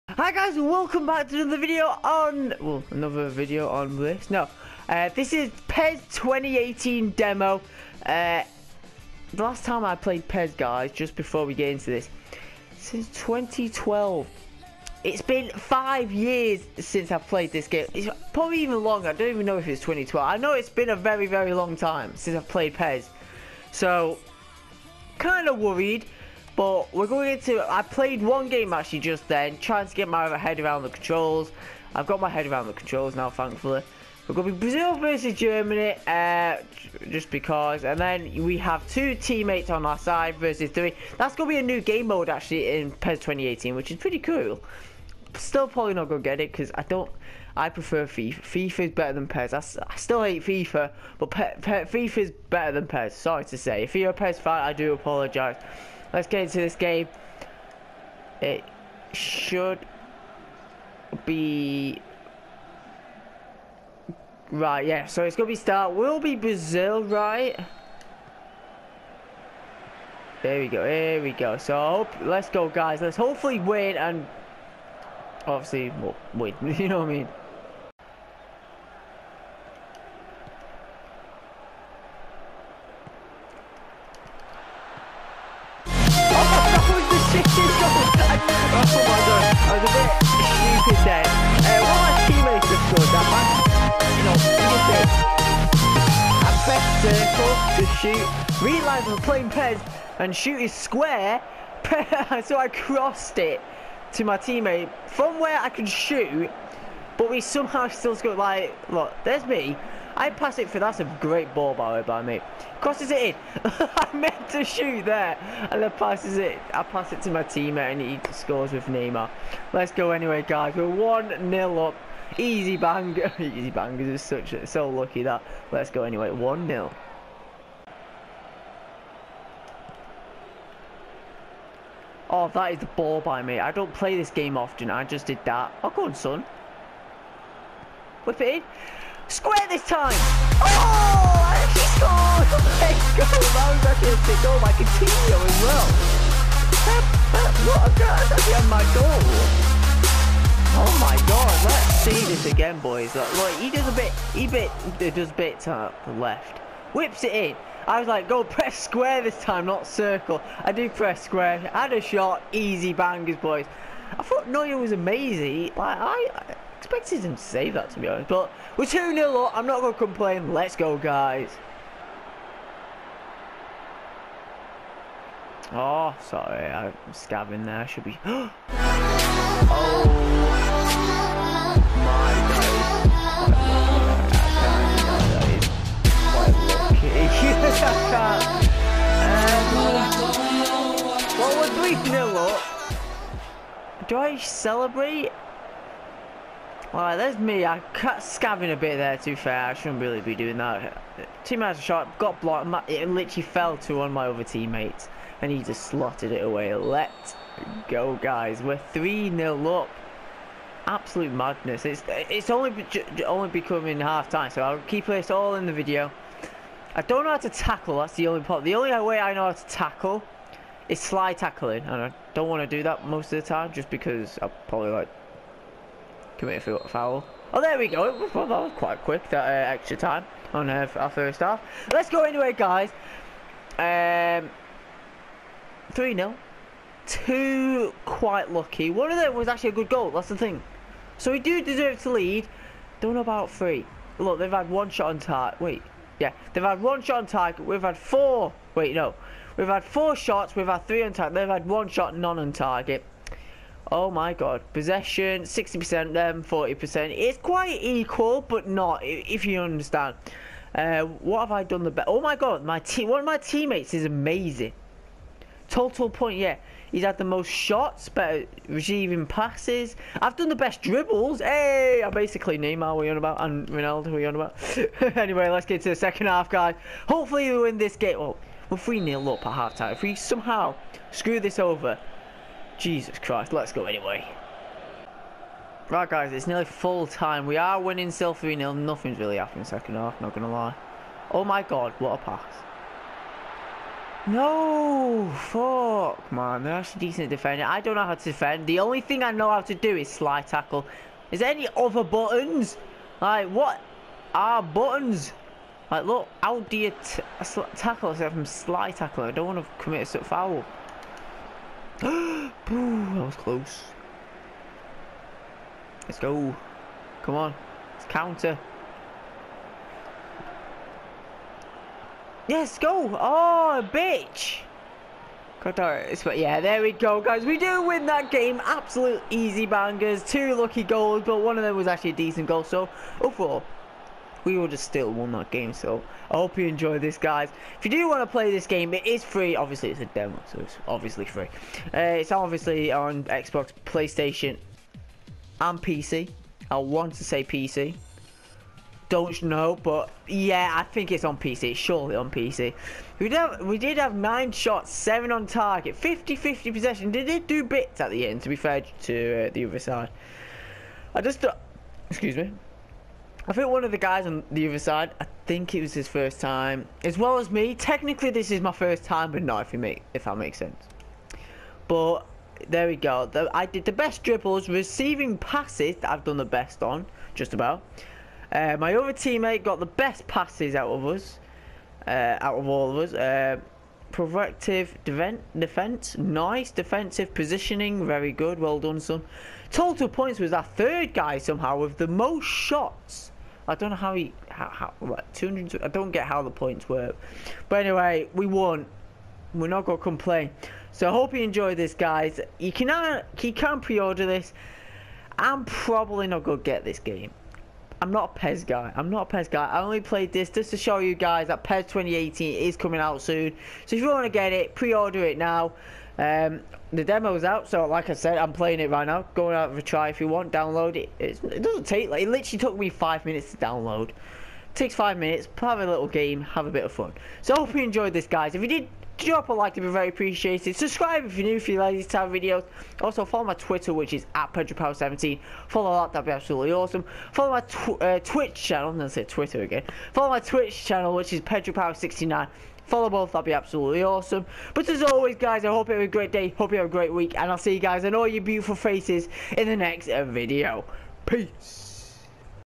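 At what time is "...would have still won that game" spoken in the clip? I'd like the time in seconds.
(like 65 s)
334 s.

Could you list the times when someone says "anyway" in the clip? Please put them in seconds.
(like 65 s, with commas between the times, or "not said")
120 s, 126 s, 232 s, 275 s, 283 s, 397 s.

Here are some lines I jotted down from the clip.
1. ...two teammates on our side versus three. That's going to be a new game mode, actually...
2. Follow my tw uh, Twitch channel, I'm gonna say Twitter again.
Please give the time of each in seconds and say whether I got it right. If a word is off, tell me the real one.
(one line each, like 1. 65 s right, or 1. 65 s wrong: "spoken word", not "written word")
1. 38 s right
2. 437 s right.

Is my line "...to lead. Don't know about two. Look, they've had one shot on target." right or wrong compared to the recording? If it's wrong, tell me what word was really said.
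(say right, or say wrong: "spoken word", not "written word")
wrong: "three", not "two".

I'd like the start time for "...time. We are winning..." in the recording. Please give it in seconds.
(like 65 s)
287 s.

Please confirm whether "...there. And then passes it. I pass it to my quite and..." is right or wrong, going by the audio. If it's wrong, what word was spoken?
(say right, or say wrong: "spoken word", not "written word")
wrong: "teammate", not "quite".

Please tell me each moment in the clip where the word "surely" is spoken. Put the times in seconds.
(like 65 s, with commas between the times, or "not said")
351 s.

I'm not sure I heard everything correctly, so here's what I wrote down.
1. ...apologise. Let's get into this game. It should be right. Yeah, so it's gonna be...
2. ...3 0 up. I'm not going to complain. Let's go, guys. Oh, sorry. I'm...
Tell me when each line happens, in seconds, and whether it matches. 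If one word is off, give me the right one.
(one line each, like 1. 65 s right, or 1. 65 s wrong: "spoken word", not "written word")
1. 54 s right
2. 168 s wrong: "2", not "3".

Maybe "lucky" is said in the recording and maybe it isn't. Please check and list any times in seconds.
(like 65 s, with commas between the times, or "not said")
124 s, 238 s, 330 s.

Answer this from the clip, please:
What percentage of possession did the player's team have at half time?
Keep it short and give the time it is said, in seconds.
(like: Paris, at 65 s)
60%, at 255 s.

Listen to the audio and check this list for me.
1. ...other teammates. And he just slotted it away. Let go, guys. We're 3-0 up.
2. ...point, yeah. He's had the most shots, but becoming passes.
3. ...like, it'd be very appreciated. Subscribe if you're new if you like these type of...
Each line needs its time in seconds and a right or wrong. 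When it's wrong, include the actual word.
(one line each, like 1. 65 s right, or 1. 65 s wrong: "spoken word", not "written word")
1. 204 s right
2. 266 s wrong: "receiving", not "becoming"
3. 429 s right.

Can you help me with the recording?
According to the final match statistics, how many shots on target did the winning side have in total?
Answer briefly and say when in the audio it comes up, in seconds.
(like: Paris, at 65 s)
7, at 354 s.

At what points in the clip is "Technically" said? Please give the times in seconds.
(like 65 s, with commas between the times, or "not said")
367 s.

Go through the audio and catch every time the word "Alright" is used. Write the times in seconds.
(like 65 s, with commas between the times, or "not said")
196 s.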